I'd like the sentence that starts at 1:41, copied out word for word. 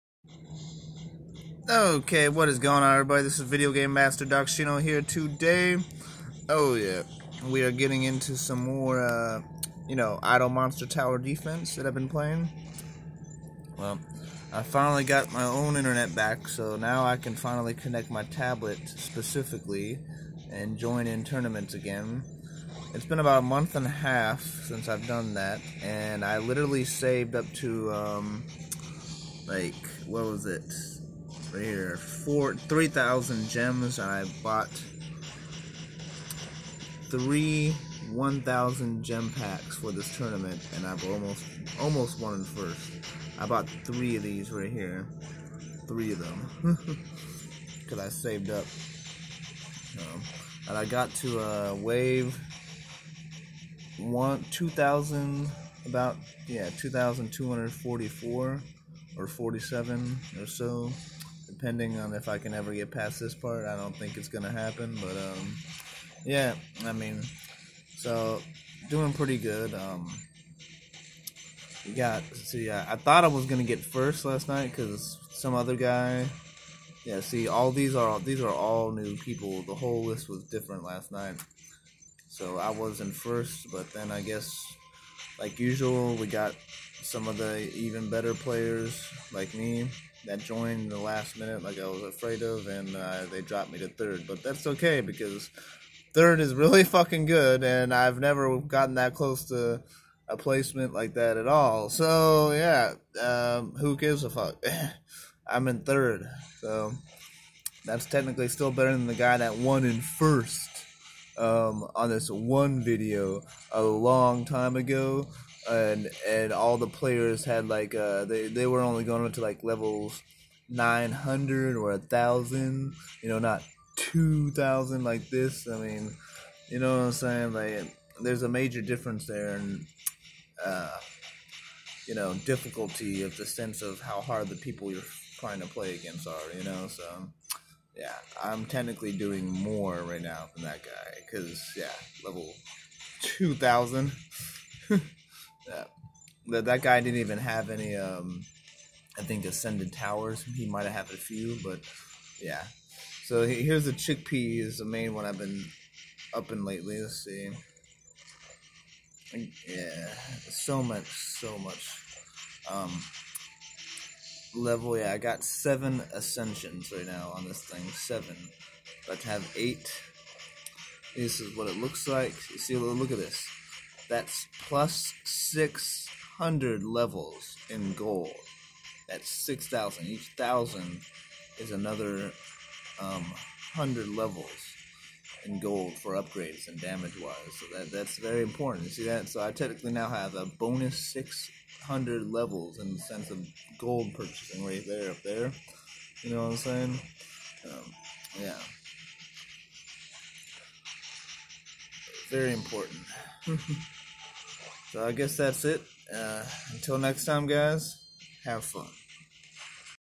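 So yeah, um, who gives a fuck?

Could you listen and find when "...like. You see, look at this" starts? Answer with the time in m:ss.
2:52.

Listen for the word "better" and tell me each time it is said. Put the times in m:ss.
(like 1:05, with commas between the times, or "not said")
1:28, 1:48.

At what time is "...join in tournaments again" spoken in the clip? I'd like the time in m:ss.
0:20.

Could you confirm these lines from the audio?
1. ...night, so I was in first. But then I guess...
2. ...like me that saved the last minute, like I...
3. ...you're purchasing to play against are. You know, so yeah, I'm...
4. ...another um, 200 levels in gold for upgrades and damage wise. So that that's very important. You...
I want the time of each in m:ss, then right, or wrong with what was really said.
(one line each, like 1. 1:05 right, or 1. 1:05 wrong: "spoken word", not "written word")
1. 1:21 right
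2. 1:29 wrong: "joined", not "saved"
3. 2:14 wrong: "trying", not "purchasing"
4. 3:01 wrong: "100", not "200".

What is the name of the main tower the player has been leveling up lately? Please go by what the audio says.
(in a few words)
Chickpea.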